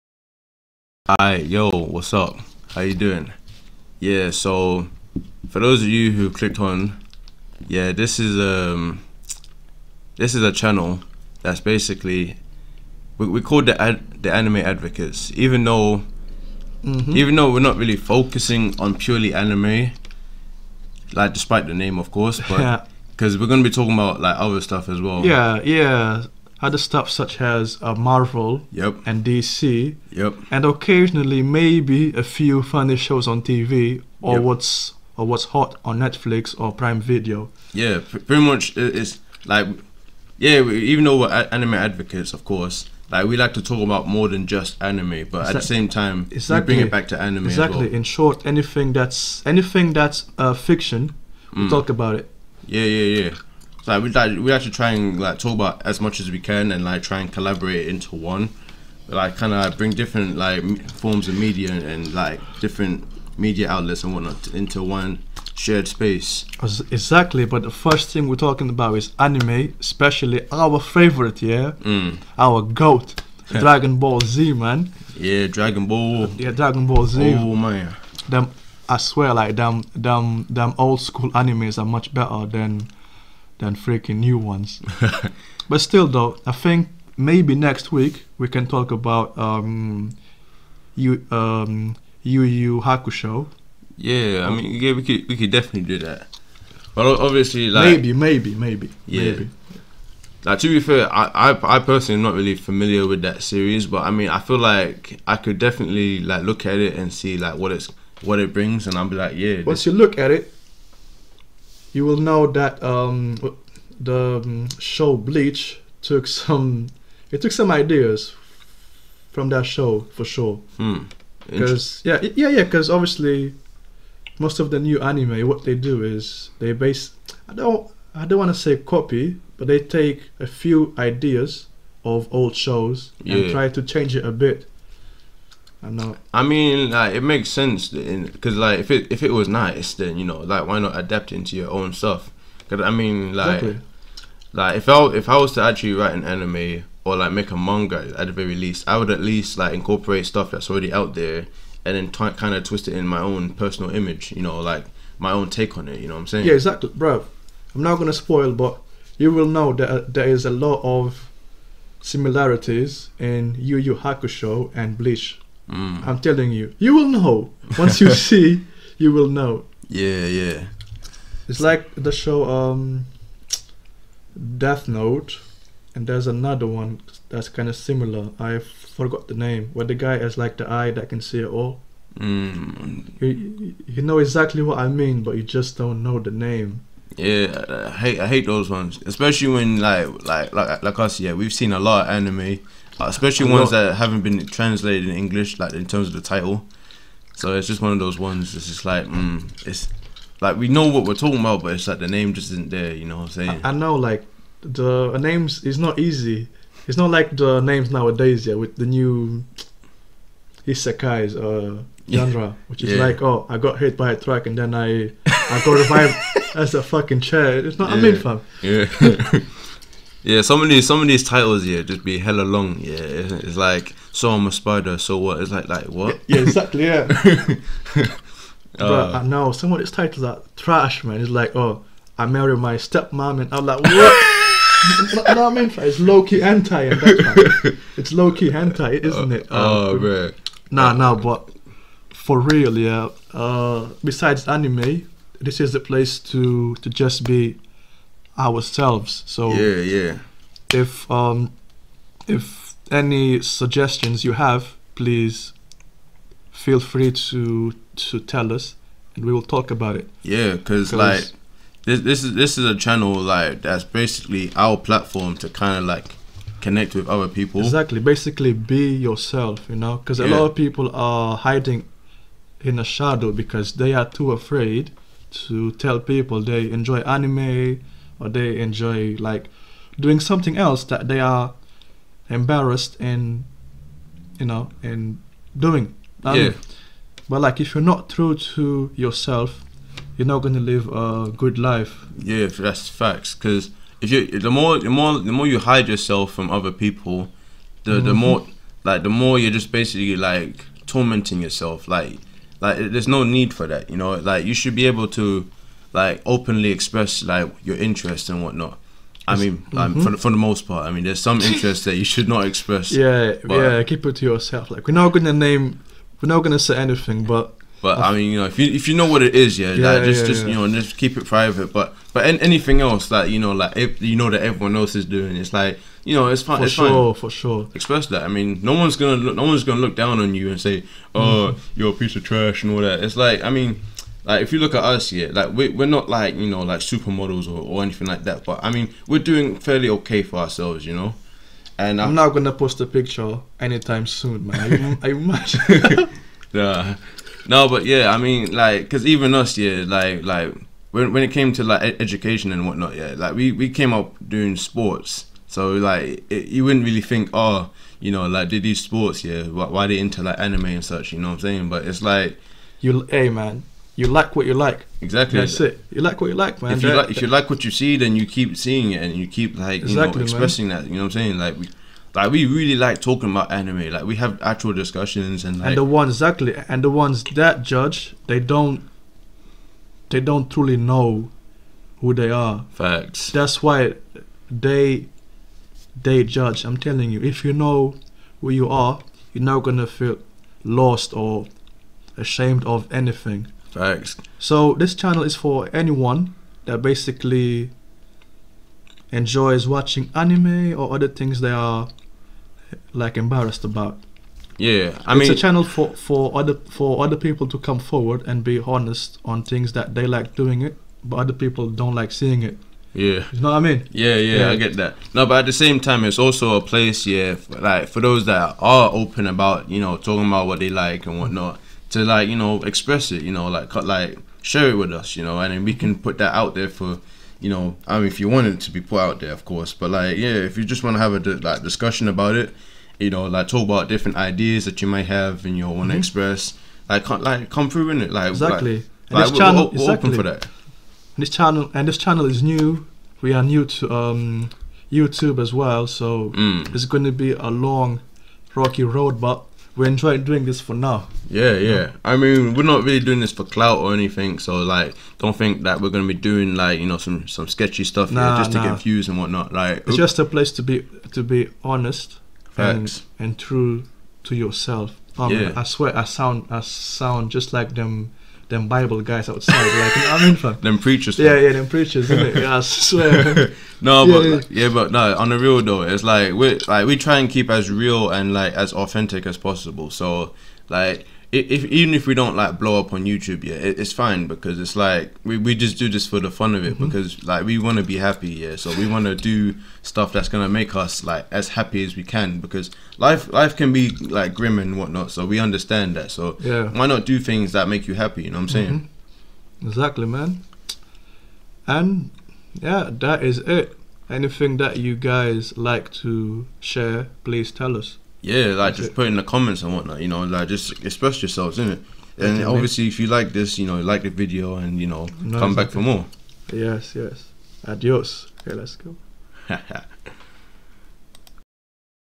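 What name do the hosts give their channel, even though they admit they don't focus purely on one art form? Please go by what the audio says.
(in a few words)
The Anime Advocates.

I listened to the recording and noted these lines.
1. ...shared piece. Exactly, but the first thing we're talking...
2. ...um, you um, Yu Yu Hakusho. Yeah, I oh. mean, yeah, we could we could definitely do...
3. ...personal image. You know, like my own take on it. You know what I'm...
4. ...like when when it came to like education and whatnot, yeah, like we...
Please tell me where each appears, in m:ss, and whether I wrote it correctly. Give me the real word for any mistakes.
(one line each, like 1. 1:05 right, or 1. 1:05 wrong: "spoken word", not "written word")
1. 1:05 wrong: "space", not "piece"
2. 1:29 right
3. 2:33 right
4. 5:50 right.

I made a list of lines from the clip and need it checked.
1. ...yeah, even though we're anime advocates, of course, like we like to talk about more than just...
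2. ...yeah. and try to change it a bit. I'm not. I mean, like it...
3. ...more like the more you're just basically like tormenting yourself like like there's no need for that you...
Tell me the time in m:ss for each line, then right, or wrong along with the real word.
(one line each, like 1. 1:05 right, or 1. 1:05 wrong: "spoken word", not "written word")
1. 0:40 right
2. 2:13 right
3. 4:58 right.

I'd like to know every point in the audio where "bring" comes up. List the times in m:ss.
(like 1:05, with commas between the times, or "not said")
0:46, 0:59, 1:48.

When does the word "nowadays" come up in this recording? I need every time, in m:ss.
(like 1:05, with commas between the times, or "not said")
3:27.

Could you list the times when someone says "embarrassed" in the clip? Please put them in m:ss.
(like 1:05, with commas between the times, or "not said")
4:42, 6:43.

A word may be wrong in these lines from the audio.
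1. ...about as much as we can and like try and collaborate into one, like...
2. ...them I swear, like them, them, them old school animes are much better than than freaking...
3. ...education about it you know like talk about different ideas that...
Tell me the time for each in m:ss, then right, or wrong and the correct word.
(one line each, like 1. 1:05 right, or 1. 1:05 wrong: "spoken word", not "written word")
1. 0:55 right
2. 1:18 right
3. 7:11 wrong: "discussion", not "education".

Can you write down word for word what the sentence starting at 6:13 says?
Like we have actual discussions and like.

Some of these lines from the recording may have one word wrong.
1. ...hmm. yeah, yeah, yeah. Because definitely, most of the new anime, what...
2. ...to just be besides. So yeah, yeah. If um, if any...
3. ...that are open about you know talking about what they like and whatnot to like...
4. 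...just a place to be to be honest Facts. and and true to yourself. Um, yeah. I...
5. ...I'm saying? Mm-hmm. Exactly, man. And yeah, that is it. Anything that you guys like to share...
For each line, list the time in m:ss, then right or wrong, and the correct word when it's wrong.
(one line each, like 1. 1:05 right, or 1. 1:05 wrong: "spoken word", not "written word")
1. 2:02 wrong: "obviously", not "definitely"
2. 4:06 wrong: "ourselves", not "besides"
3. 6:58 right
4. 7:39 right
5. 8:18 right.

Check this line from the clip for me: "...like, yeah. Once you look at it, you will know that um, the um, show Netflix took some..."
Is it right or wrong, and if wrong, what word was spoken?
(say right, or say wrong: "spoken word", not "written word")
wrong: "Bleach", not "Netflix".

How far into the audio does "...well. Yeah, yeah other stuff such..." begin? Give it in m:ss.
0:25.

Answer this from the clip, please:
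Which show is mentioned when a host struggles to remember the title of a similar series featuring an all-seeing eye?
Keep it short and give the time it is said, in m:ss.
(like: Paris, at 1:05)
Death Note, at 2:54.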